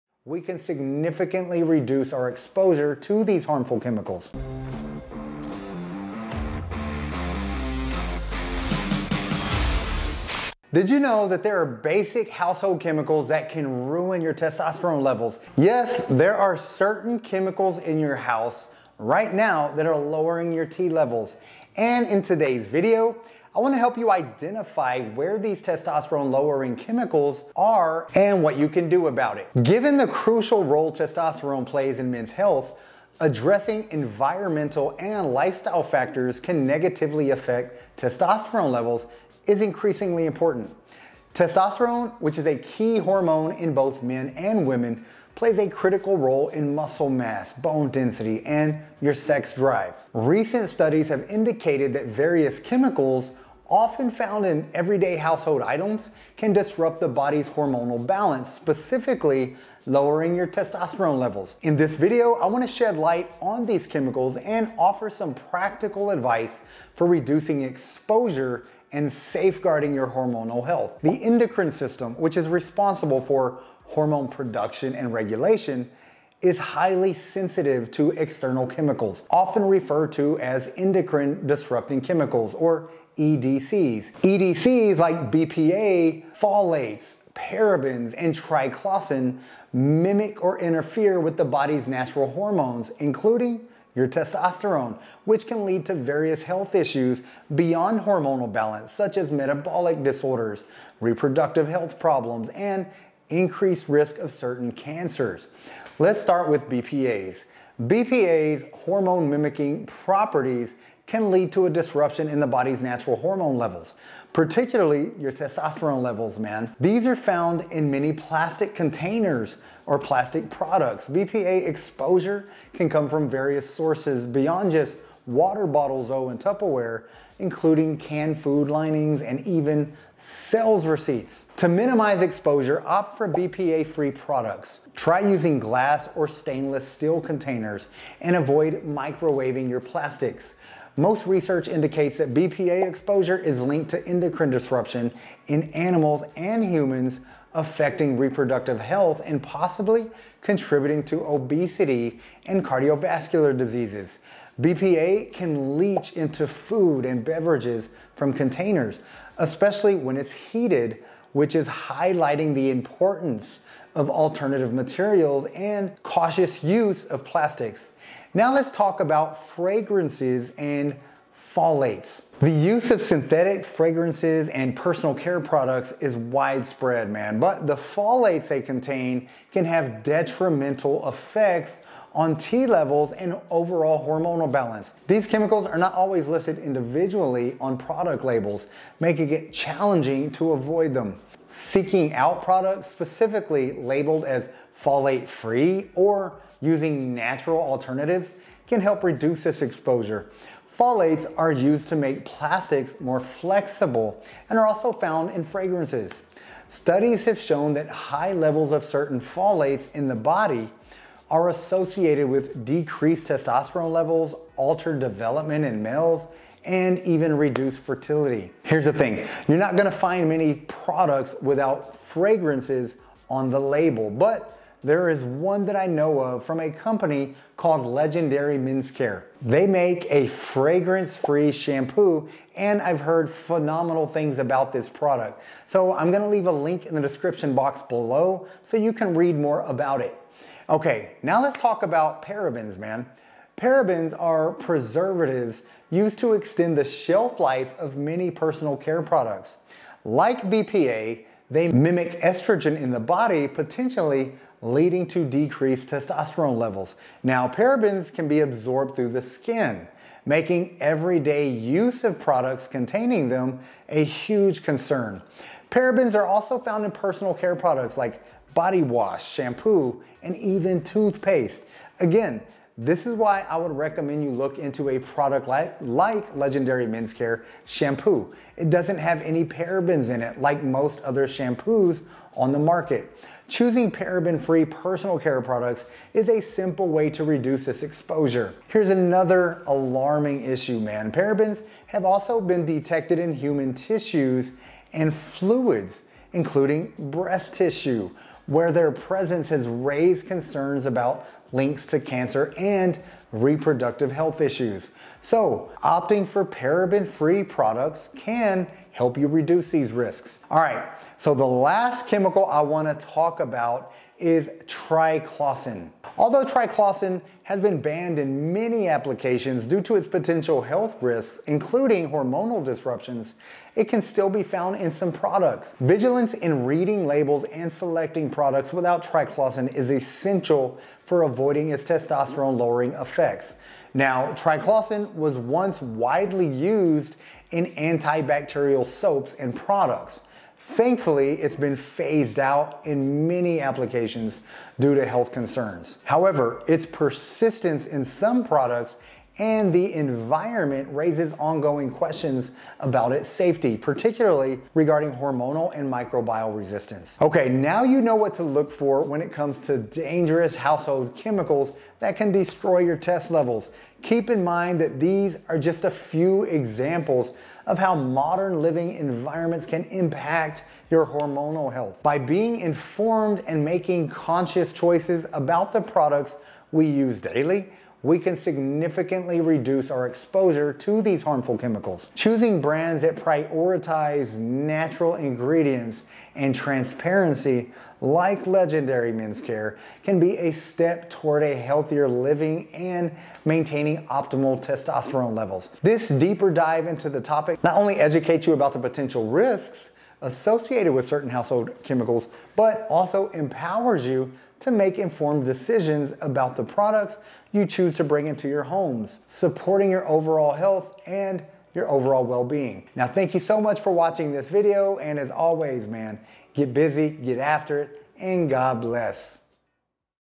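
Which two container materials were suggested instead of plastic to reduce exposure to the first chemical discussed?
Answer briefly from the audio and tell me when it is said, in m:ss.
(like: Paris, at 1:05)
glass or stainless steel, at 2:15.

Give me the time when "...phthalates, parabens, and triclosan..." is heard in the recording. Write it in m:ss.
1:26.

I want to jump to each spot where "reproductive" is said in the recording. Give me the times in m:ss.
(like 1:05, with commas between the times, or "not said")
1:41, 2:28, 5:03.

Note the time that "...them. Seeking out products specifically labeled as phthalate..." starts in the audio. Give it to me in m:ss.
3:10.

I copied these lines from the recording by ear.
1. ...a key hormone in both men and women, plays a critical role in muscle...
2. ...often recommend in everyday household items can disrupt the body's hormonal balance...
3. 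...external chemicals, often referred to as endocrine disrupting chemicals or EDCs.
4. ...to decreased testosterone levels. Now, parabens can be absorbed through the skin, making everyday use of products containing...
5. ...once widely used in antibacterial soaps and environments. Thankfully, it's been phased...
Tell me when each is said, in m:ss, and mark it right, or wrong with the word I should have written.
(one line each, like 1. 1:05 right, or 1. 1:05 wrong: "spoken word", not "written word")
1. 0:42 right
2. 0:53 wrong: "found", not "recommend"
3. 1:18 right
4. 4:15 right
5. 5:35 wrong: "products", not "environments".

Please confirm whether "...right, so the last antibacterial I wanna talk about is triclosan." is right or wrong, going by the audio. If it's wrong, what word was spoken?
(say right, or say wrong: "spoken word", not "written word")
wrong: "chemical", not "antibacterial".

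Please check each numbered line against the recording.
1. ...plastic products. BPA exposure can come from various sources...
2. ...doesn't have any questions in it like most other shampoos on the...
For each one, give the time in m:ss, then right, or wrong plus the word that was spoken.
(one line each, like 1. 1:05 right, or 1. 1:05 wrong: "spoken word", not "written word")
1. 1:59 right
2. 4:38 wrong: "parabens", not "questions".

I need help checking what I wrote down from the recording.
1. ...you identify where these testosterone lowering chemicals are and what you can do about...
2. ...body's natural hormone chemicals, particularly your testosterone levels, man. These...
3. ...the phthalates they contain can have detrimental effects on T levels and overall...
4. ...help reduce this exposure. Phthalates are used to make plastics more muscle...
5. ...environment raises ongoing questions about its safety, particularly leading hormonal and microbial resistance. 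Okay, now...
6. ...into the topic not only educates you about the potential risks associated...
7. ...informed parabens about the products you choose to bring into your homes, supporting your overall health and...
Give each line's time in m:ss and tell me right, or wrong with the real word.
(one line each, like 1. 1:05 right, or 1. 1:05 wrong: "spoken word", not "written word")
1. 0:23 right
2. 1:52 wrong: "levels", not "chemicals"
3. 2:57 right
4. 3:18 wrong: "flexible", not "muscle"
5. 5:49 wrong: "regarding", not "leading"
6. 6:36 right
7. 6:44 wrong: "decisions", not "parabens".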